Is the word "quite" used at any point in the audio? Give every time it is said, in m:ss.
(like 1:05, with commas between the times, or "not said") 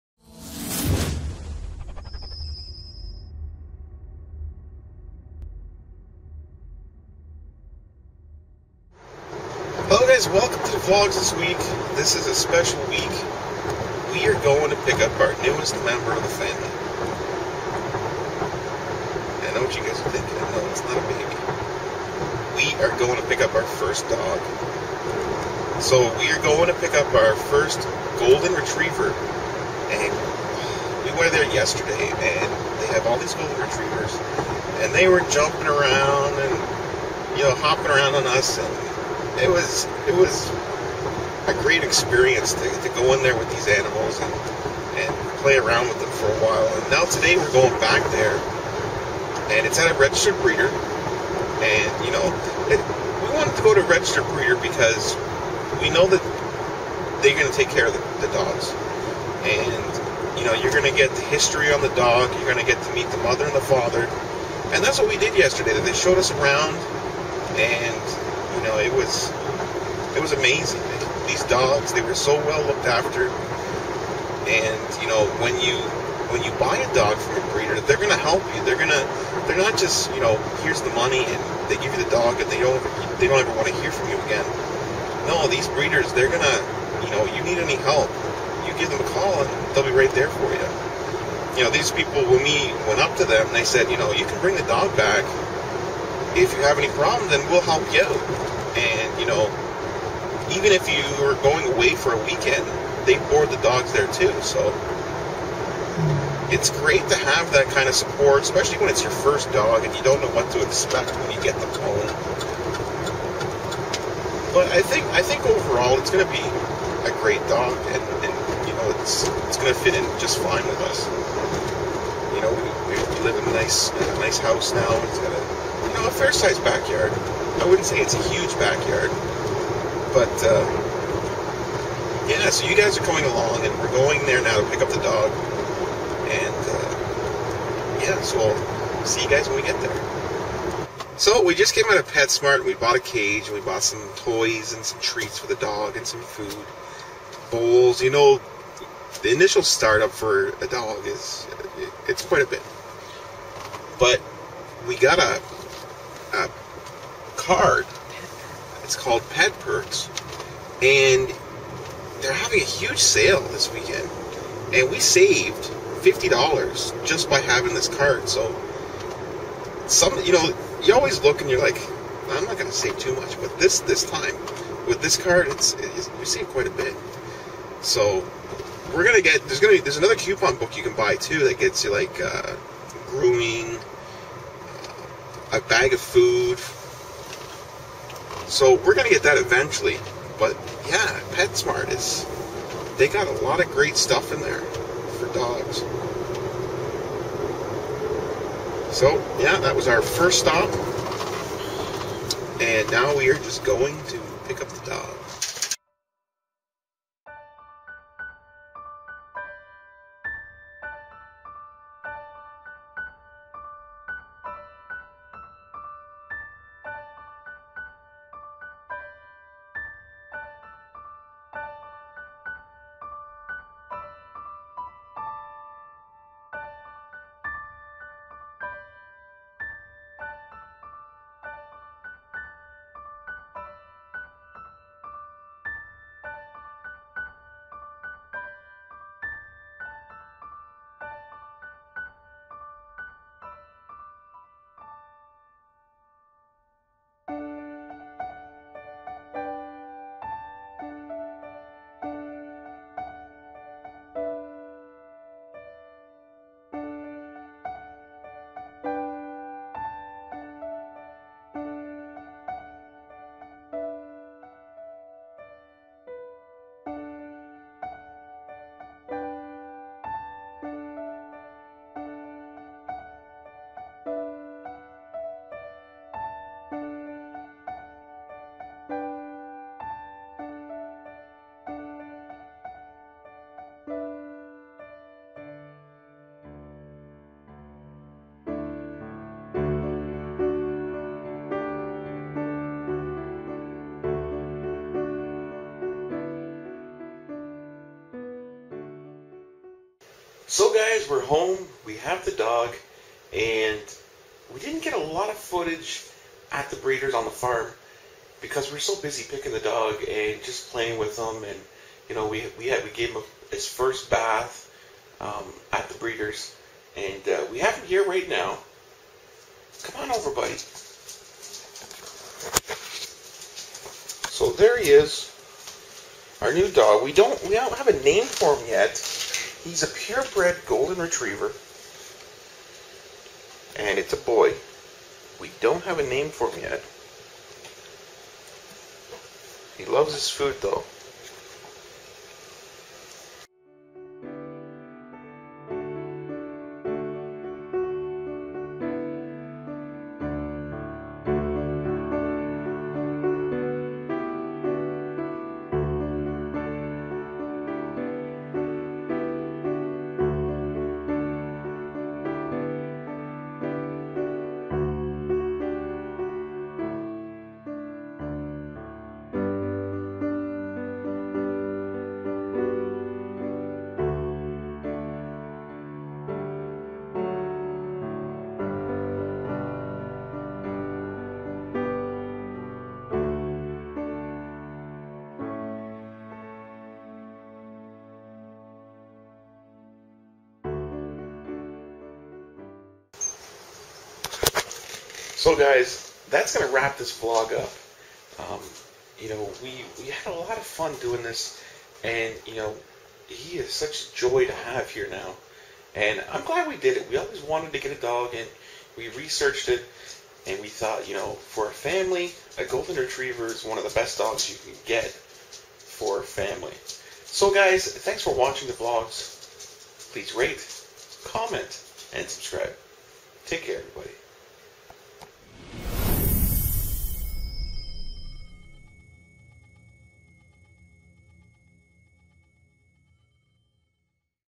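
2:32, 2:56.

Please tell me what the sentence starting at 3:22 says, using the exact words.
And now we are just going to pick up the dogs.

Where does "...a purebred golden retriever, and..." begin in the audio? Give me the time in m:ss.
5:29.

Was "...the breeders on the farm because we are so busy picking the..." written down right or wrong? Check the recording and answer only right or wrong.
right.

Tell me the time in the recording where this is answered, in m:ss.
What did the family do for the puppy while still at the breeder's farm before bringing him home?
5:13.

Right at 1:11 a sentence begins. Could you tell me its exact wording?
These dogs, they were so well looked after.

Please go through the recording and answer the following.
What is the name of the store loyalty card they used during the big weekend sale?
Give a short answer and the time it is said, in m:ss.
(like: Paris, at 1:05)
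Pet Perks, at 2:39.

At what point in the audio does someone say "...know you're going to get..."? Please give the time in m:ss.
1:00.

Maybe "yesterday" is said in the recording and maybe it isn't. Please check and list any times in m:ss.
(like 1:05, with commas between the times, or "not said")
0:31, 1:05.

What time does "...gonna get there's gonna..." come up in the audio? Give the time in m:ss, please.
2:59.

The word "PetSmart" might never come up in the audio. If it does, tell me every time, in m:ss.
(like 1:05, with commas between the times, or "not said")
2:22, 3:11.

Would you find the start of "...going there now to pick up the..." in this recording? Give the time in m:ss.
2:13.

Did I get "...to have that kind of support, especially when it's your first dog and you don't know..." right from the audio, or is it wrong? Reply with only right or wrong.
right.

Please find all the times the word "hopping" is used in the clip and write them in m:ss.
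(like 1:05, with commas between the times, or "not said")
0:37.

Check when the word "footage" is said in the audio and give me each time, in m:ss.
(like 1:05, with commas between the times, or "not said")
5:05.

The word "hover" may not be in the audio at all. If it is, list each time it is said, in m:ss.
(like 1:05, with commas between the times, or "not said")
not said.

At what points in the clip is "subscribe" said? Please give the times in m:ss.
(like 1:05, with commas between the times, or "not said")
7:02.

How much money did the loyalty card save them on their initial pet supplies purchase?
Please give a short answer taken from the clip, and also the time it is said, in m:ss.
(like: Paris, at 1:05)
$50, at 2:46.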